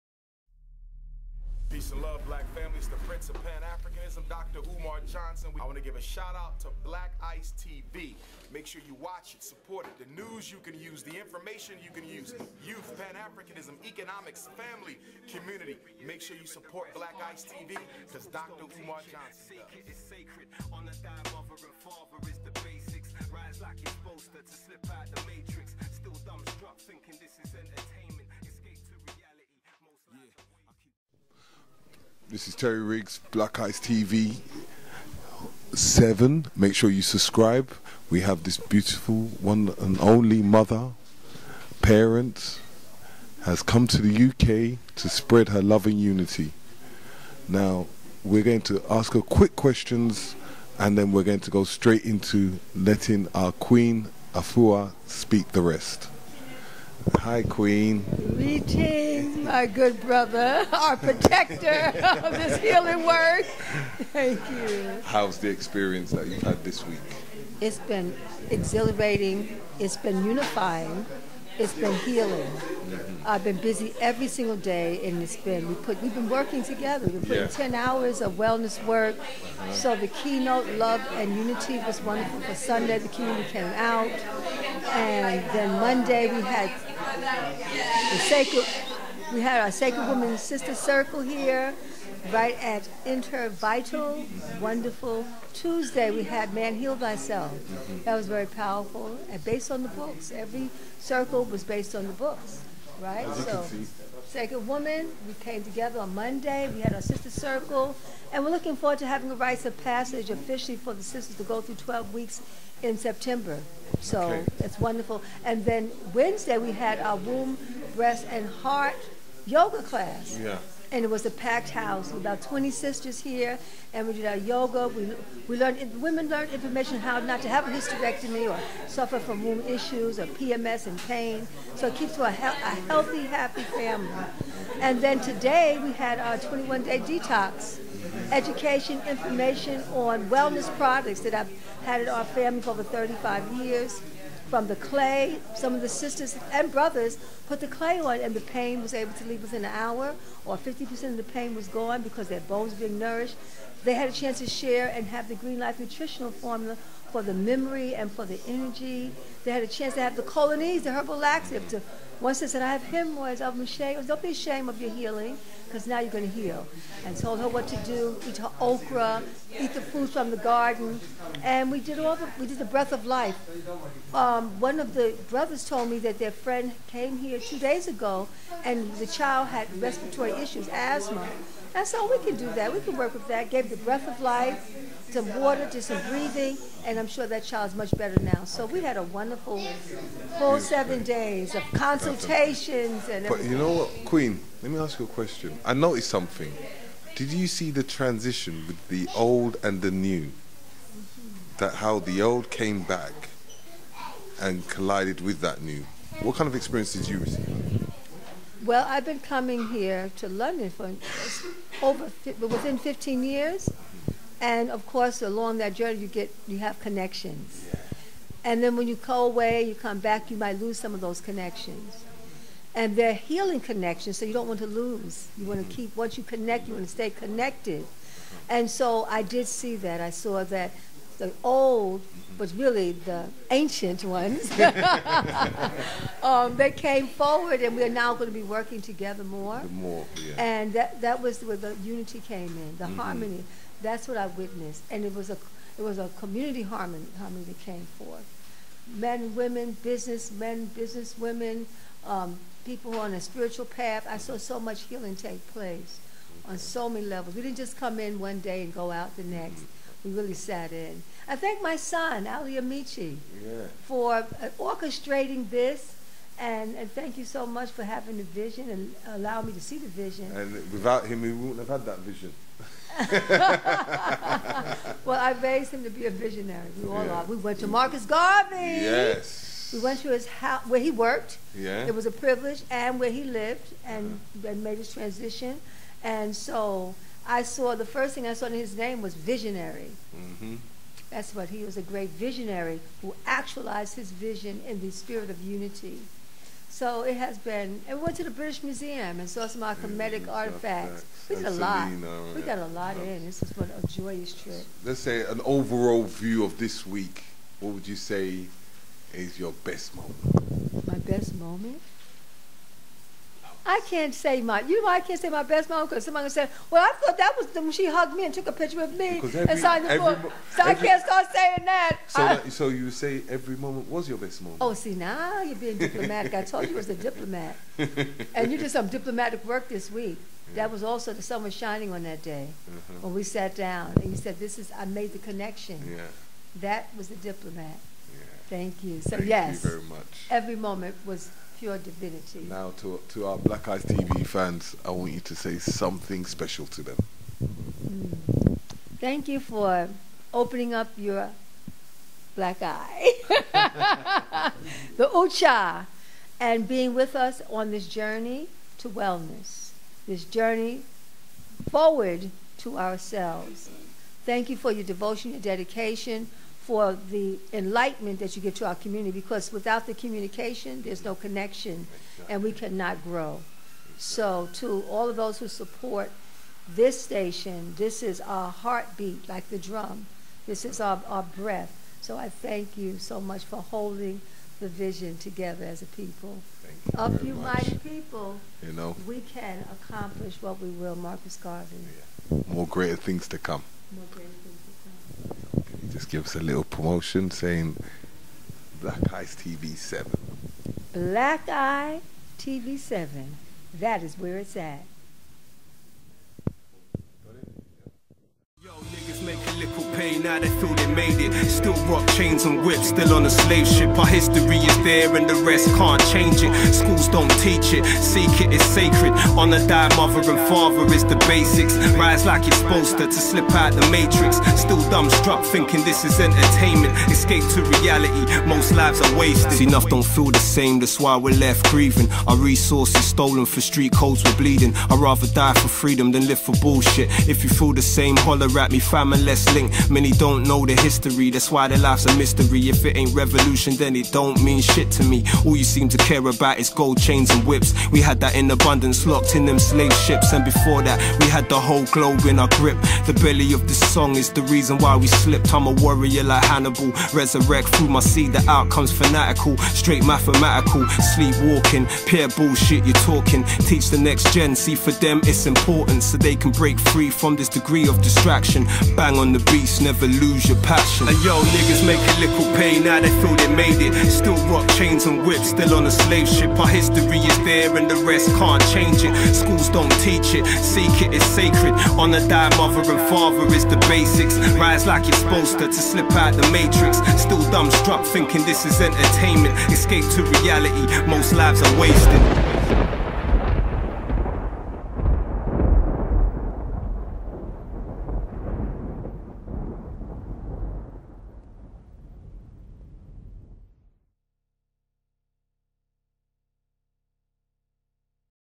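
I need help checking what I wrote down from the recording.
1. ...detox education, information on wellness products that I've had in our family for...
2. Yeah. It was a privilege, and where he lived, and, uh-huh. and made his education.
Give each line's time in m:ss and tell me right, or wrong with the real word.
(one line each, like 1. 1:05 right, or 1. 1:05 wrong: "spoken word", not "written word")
1. 2:16 right
2. 4:41 wrong: "transition", not "education".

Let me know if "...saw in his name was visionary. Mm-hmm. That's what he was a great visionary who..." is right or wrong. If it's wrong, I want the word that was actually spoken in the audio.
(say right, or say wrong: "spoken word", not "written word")
right.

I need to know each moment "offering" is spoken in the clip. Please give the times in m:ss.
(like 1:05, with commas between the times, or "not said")
not said.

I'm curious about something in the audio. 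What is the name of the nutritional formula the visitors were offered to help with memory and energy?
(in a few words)
Green Life.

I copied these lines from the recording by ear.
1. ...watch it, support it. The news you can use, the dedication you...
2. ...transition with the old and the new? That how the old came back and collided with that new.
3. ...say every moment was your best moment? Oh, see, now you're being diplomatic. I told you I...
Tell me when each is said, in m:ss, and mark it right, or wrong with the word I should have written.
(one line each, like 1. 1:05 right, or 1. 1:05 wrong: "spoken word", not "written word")
1. 0:09 wrong: "information", not "dedication"
2. 3:17 right
3. 5:22 right.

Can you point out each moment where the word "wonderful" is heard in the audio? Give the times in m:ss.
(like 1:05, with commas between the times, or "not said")
1:22, 1:34, 1:54, 3:09.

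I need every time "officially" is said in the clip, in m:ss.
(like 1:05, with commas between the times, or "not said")
1:50.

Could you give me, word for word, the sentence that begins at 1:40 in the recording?
Every circle was based on the books, right?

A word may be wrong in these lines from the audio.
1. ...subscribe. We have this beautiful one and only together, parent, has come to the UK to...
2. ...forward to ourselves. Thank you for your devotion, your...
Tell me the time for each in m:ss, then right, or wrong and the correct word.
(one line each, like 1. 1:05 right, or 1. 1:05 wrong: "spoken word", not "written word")
1. 0:37 wrong: "mother", not "together"
2. 6:01 right.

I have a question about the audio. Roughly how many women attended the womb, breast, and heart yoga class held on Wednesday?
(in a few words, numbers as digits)
20.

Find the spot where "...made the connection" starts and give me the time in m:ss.
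5:34.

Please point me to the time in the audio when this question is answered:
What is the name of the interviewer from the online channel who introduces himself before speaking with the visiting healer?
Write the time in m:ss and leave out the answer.
0:32.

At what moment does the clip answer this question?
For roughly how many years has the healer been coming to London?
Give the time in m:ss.
3:32.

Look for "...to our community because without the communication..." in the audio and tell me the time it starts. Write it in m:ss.
6:08.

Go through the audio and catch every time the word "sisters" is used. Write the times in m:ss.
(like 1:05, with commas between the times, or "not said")
1:30, 1:47, 1:51, 2:02, 2:25.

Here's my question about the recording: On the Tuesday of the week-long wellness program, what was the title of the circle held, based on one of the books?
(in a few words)
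Man Heal Thyself.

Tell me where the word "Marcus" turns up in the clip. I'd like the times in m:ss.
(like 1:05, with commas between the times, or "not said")
4:37, 6:30.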